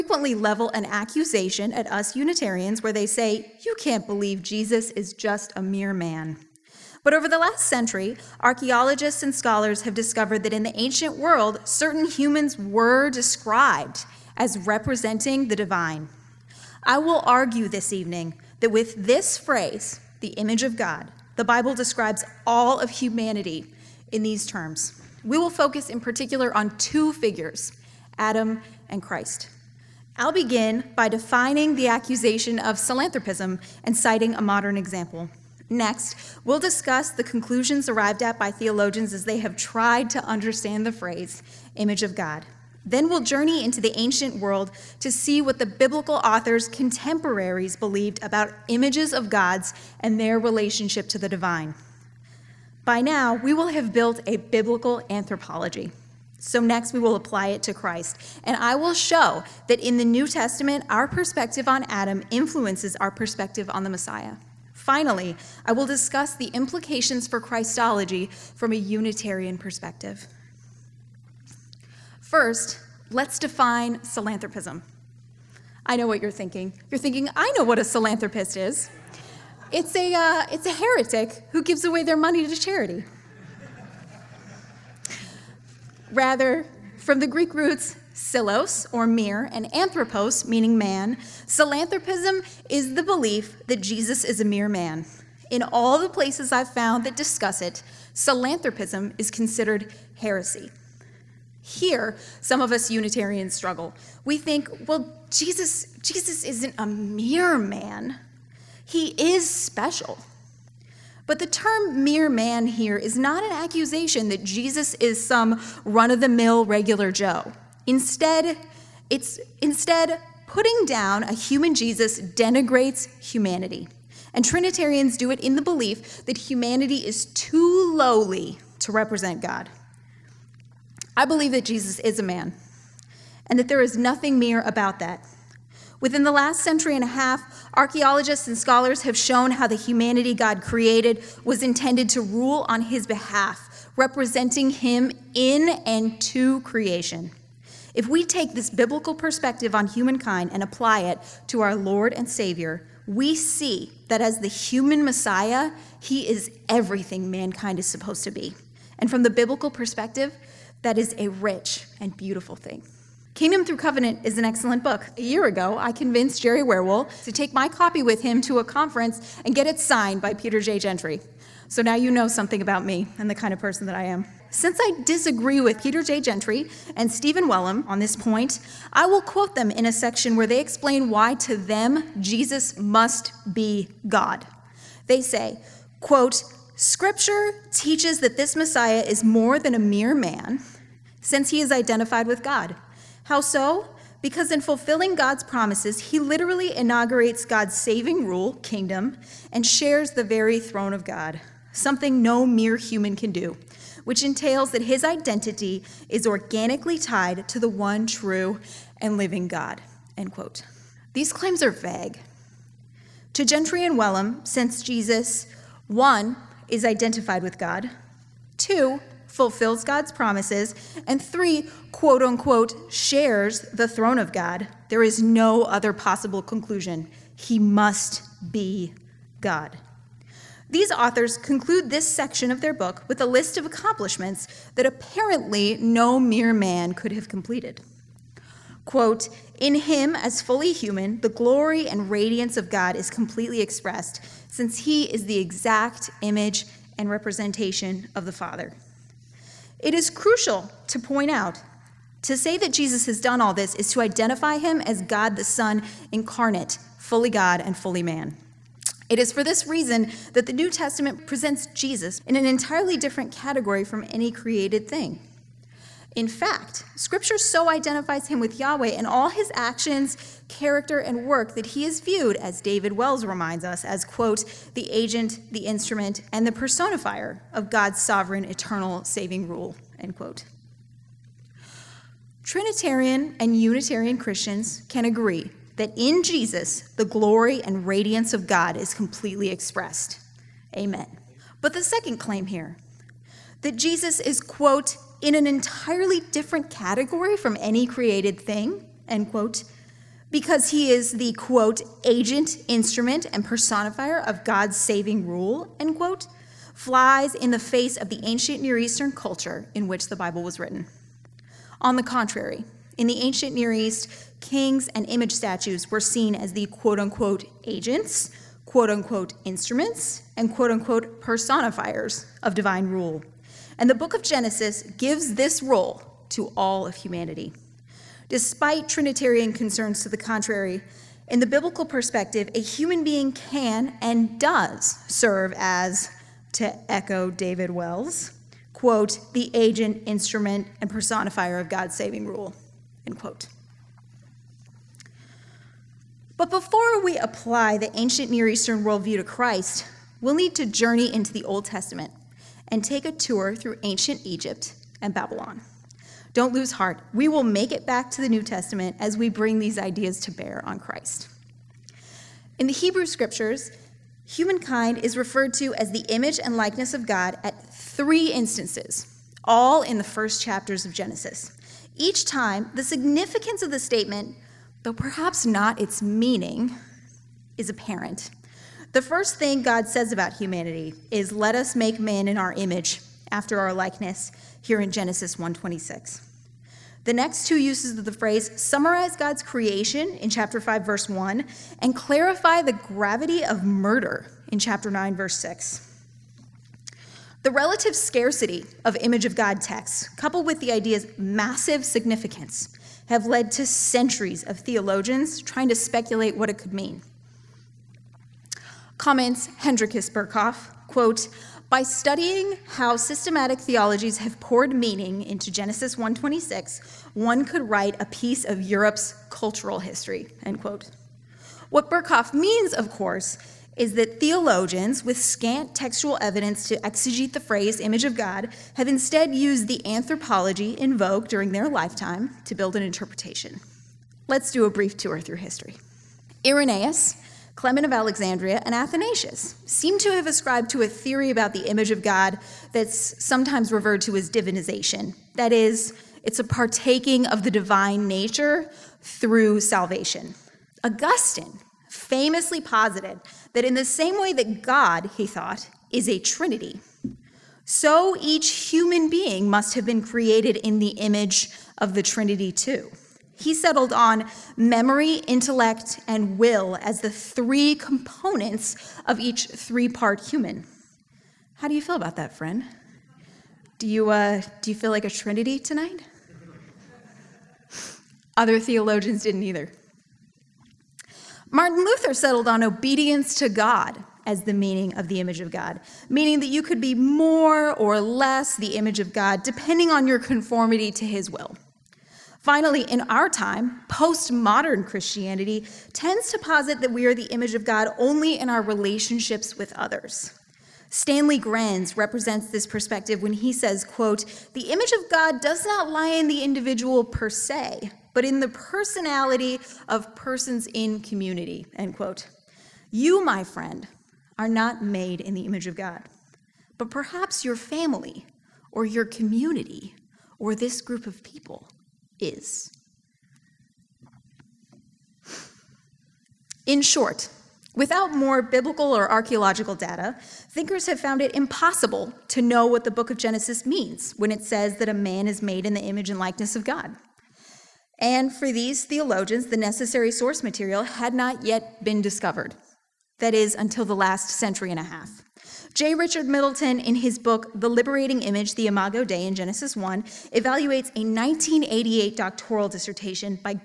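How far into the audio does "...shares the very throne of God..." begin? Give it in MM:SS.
03:19.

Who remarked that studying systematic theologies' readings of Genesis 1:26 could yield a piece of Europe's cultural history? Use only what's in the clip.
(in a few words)
Hendrikus Berkhof.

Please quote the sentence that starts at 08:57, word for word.
And for these theologians, the necessary source material had not yet been discovered.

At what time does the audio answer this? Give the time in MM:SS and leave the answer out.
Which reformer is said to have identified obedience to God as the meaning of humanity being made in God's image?
08:01.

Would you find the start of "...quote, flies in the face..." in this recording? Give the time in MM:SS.
05:05.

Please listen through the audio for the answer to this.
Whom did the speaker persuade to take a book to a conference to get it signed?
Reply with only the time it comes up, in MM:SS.
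02:46.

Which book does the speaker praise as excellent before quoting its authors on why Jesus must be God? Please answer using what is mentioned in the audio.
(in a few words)
Kingdom Through Covenant.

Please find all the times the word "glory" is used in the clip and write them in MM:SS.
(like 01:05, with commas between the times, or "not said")
04:01, 04:47.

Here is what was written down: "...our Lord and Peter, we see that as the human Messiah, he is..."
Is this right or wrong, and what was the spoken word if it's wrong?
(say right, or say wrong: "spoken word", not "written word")
wrong: "Savior", not "Peter".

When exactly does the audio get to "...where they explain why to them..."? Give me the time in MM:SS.
03:00.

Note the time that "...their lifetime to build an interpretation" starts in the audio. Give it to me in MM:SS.
07:11.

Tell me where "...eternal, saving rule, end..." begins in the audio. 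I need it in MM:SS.
04:38.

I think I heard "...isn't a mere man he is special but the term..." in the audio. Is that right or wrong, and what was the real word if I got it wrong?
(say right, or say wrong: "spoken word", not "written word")
right.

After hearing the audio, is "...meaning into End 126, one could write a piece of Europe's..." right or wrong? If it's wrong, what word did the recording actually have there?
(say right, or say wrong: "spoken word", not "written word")
wrong: "Genesis", not "End".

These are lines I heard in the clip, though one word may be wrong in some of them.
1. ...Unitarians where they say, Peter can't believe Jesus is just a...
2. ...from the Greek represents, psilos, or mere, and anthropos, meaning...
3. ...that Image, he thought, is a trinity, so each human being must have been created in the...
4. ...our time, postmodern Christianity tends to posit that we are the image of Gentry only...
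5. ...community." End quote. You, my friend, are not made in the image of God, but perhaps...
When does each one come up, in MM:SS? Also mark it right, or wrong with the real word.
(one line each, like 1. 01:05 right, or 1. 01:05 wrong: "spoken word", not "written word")
1. 00:02 wrong: "You", not "Peter"
2. 01:26 wrong: "roots", not "represents"
3. 07:34 wrong: "God", not "Image"
4. 08:13 wrong: "God", not "Gentry"
5. 08:30 right.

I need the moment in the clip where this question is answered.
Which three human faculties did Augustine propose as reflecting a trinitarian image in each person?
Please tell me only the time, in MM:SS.
07:44.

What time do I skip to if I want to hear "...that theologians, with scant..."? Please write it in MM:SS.
07:03.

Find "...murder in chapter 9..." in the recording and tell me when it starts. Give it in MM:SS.
06:33.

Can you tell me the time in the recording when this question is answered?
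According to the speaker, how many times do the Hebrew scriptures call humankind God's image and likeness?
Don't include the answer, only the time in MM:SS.
06:07.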